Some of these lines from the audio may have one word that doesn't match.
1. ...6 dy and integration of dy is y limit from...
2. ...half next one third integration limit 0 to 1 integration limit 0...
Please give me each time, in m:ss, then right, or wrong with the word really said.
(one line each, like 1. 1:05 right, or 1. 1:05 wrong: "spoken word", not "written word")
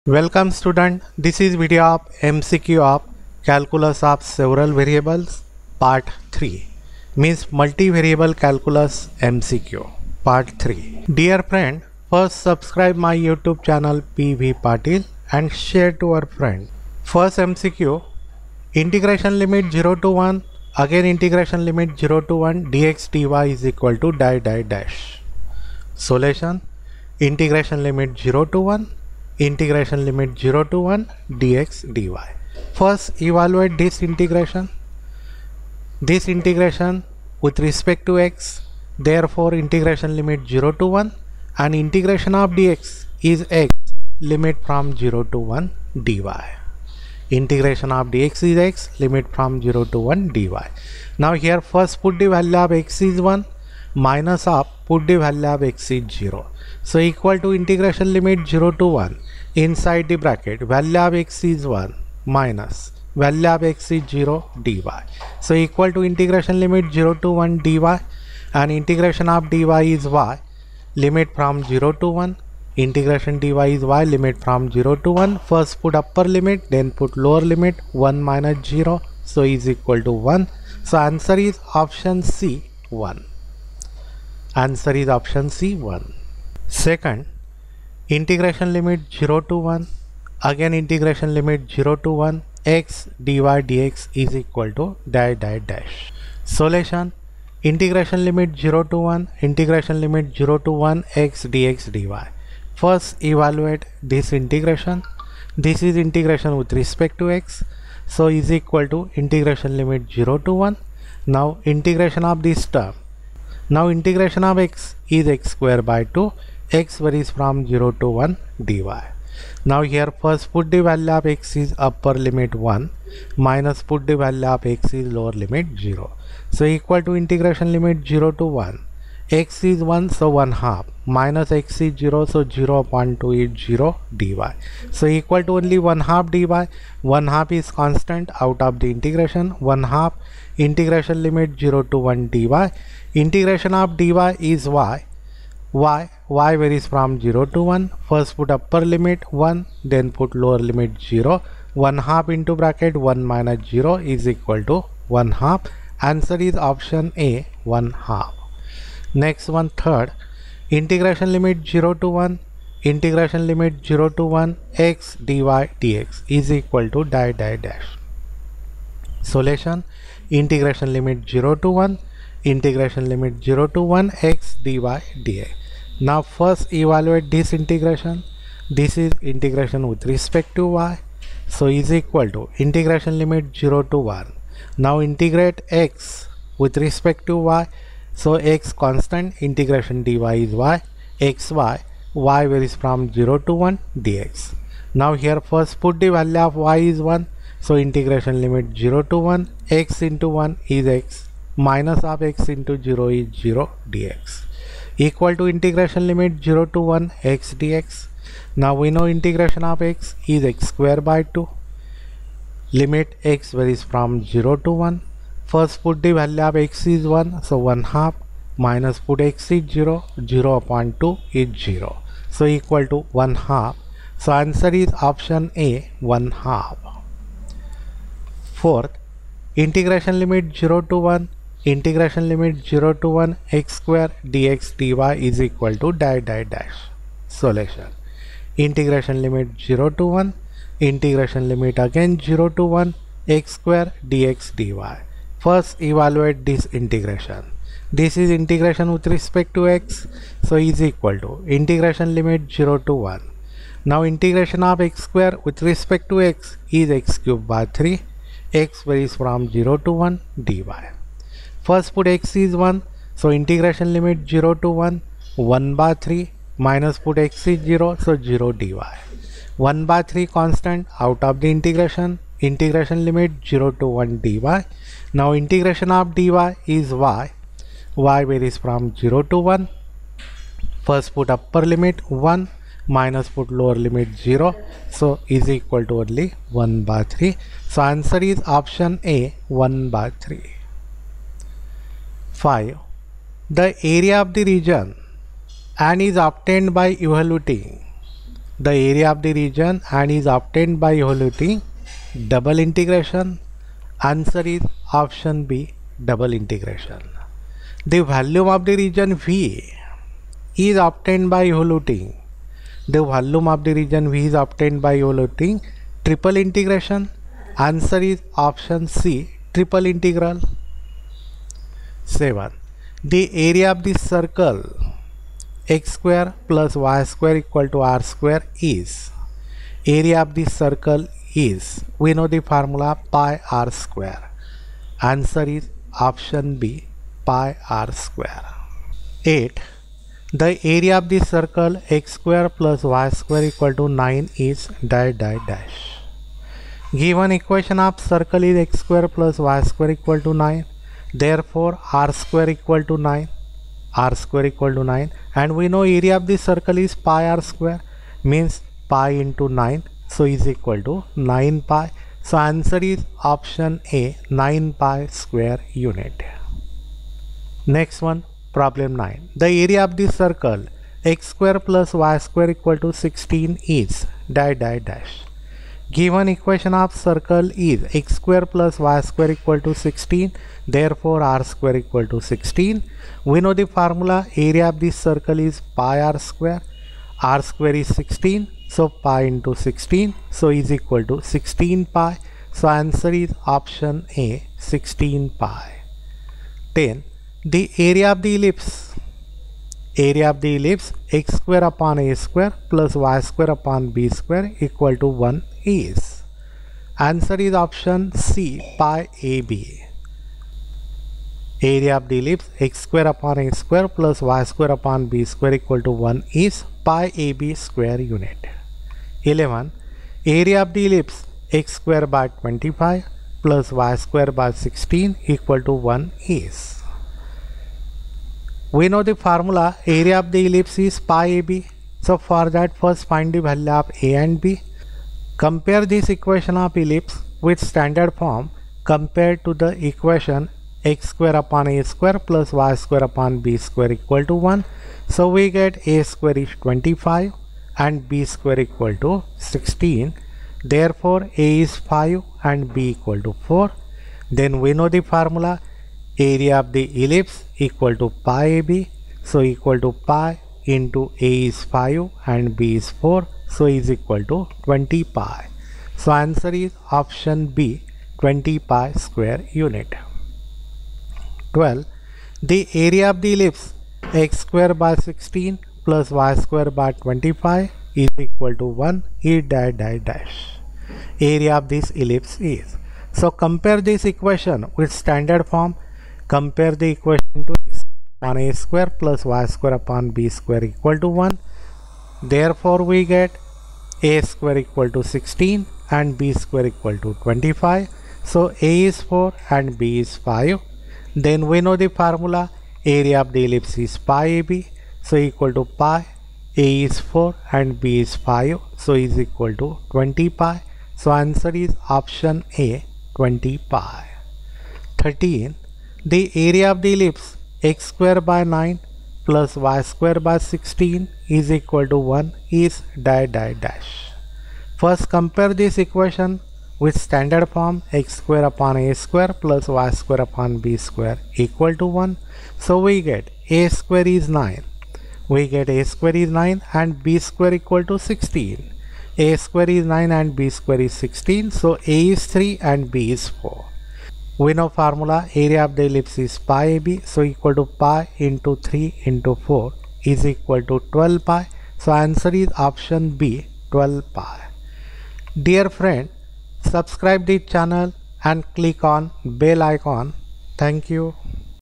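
1. 1:07 wrong: "1", not "6"
2. 2:38 right.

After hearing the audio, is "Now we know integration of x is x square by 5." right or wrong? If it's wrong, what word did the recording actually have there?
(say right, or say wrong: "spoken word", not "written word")
wrong: "2", not "5".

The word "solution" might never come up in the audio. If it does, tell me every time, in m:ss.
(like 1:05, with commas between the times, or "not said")
0:25, 1:36, 2:49.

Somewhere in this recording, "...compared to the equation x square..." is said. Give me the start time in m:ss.
7:18.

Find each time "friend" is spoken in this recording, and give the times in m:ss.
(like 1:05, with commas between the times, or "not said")
0:11, 0:16, 9:15.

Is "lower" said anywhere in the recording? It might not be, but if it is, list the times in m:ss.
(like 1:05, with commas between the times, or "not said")
1:17, 2:05, 2:30, 4:43.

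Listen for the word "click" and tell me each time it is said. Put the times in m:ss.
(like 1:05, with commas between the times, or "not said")
9:18.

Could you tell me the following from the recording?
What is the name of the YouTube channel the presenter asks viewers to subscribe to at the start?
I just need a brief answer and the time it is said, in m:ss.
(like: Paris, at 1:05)
PV Patil, at 0:14.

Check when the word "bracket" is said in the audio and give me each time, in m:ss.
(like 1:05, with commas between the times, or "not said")
1:00, 2:32.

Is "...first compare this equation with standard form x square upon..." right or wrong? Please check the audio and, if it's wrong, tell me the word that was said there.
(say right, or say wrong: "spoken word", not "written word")
right.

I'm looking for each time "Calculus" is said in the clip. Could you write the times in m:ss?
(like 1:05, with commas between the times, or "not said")
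0:03, 0:08.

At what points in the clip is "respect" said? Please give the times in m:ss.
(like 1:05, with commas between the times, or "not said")
0:37, 1:46, 3:00, 3:06, 4:09, 4:15.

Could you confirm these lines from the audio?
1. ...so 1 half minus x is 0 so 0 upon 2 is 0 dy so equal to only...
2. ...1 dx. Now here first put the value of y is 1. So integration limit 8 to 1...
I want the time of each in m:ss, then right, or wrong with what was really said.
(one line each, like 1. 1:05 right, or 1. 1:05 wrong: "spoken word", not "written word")
1. 2:10 right
2. 3:13 wrong: "0", not "8".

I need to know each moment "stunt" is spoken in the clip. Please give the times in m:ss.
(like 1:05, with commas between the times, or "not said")
not said.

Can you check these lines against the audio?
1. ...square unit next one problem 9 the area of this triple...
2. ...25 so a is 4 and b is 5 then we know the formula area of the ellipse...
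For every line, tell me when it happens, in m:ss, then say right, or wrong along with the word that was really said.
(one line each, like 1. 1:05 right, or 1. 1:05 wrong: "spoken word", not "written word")
1. 6:05 wrong: "circle", not "triple"
2. 8:17 right.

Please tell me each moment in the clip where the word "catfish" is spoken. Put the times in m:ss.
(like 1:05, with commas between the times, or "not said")
not said.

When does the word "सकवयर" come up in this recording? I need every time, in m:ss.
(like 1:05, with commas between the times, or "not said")
3:53, 4:03.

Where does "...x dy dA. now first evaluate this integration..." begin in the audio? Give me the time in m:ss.
2:54.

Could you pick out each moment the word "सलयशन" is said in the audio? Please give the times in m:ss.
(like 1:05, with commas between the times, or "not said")
3:57.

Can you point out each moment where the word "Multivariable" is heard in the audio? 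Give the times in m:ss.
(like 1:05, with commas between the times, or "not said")
0:07.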